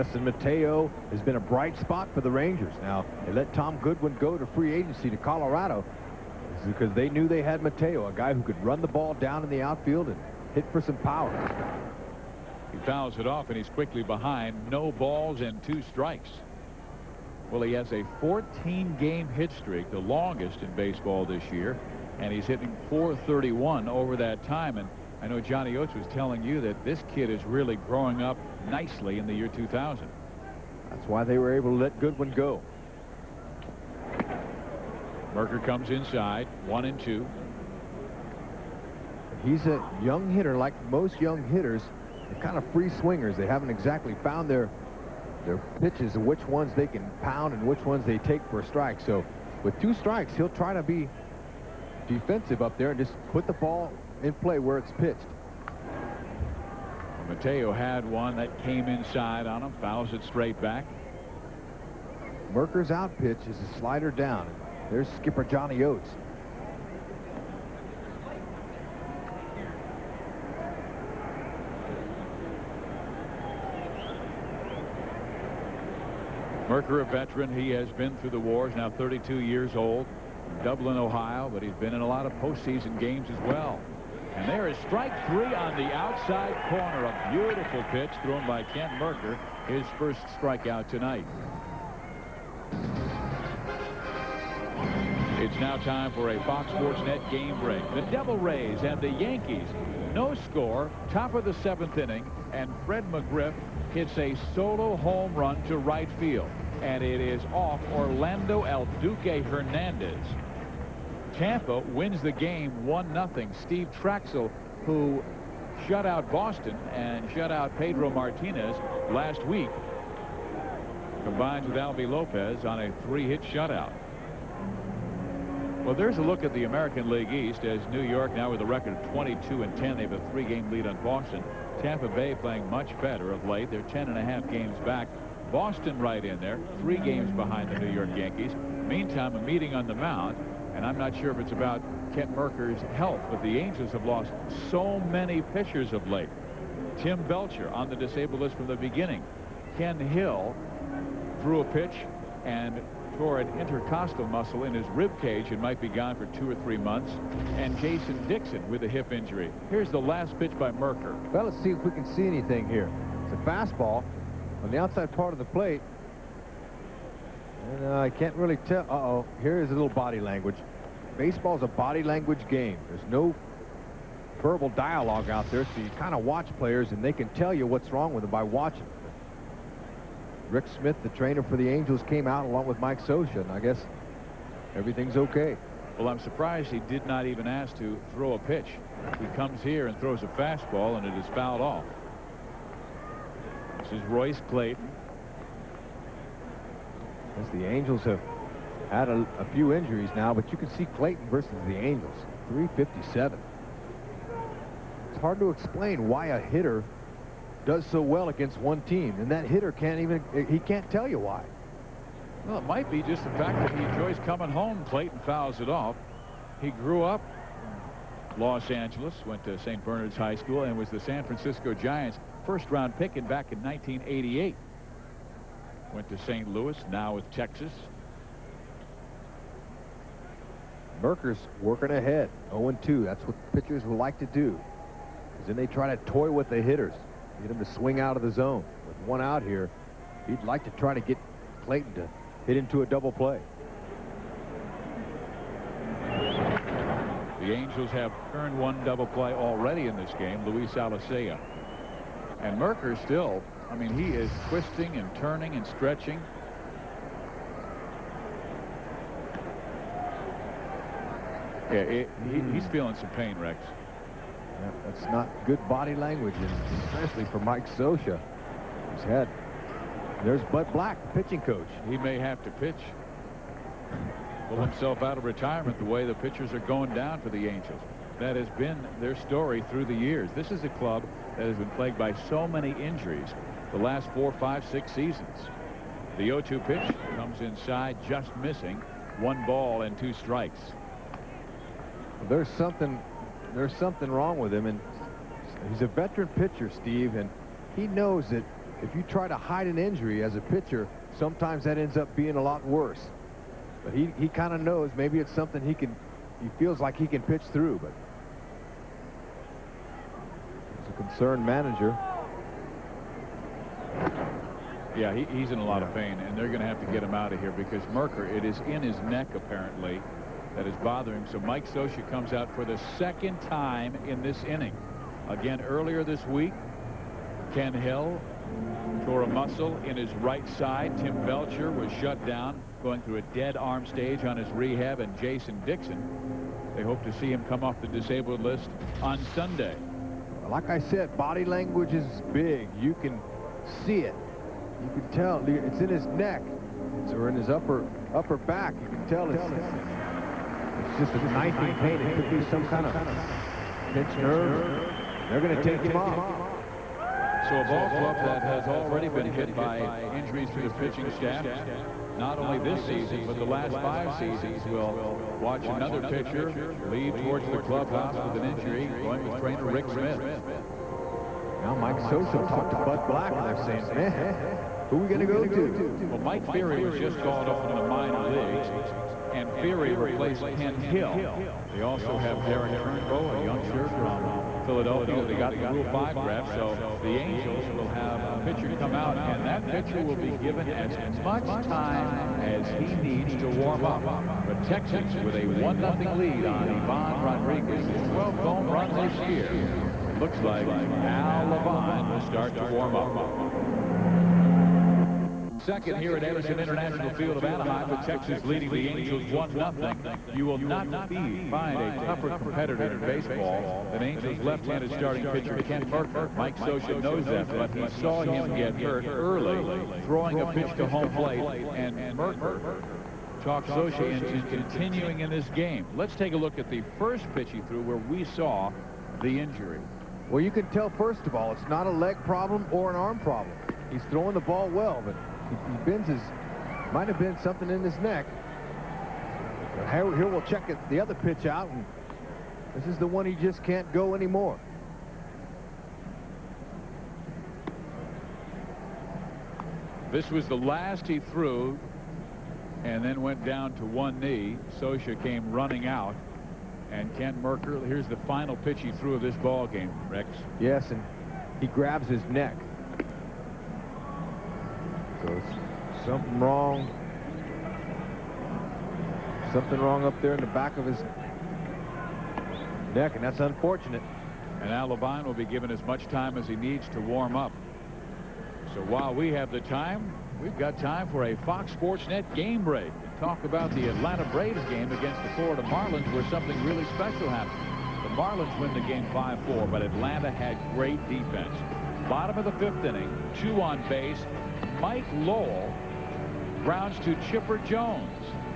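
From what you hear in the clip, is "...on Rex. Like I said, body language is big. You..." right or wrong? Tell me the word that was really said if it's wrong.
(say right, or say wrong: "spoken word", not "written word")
wrong: "Sunday", not "Rex".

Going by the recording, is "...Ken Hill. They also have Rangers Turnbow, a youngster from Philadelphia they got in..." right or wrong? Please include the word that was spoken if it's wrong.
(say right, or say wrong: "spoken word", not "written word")
wrong: "Derrick", not "Rangers".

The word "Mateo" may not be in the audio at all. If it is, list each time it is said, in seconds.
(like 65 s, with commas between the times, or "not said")
0 s, 7 s, 57 s.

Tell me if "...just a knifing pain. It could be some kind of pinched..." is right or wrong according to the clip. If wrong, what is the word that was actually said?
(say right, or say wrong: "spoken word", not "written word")
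right.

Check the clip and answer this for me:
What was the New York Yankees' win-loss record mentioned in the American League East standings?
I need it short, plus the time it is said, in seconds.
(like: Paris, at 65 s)
22 and 10, at 129 s.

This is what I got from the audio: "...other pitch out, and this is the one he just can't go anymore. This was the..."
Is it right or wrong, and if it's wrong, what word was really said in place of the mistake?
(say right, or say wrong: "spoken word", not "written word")
right.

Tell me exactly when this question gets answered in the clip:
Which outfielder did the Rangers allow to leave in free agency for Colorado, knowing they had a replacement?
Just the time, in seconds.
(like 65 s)
3 s.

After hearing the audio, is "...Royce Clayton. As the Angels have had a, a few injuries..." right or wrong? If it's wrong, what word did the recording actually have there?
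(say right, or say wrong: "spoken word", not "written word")
right.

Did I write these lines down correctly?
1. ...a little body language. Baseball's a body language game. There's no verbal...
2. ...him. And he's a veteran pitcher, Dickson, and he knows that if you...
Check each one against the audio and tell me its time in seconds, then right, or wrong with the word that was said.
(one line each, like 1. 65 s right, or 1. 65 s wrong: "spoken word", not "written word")
1. 169 s right
2. 294 s wrong: "Steve", not "Dickson".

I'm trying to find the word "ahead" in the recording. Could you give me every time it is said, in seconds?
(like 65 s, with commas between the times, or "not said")
231 s.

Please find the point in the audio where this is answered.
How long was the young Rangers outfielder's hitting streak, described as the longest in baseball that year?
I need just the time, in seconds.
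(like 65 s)
18 s.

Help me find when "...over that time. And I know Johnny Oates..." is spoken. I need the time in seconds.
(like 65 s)
23 s.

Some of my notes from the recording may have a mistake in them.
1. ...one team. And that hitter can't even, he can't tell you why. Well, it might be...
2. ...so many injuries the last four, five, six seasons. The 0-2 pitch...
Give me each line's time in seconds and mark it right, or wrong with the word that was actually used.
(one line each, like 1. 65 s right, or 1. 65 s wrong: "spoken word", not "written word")
1. 208 s right
2. 282 s right.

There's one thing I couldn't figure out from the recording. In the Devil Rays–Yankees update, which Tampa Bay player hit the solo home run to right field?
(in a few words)
Fred McGriff.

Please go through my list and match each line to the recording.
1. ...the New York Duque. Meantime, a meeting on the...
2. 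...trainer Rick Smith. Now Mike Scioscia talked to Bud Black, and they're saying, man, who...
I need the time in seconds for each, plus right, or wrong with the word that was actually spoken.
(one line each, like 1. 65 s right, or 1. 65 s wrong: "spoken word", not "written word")
1. 137 s wrong: "Yankees", not "Duque"
2. 369 s right.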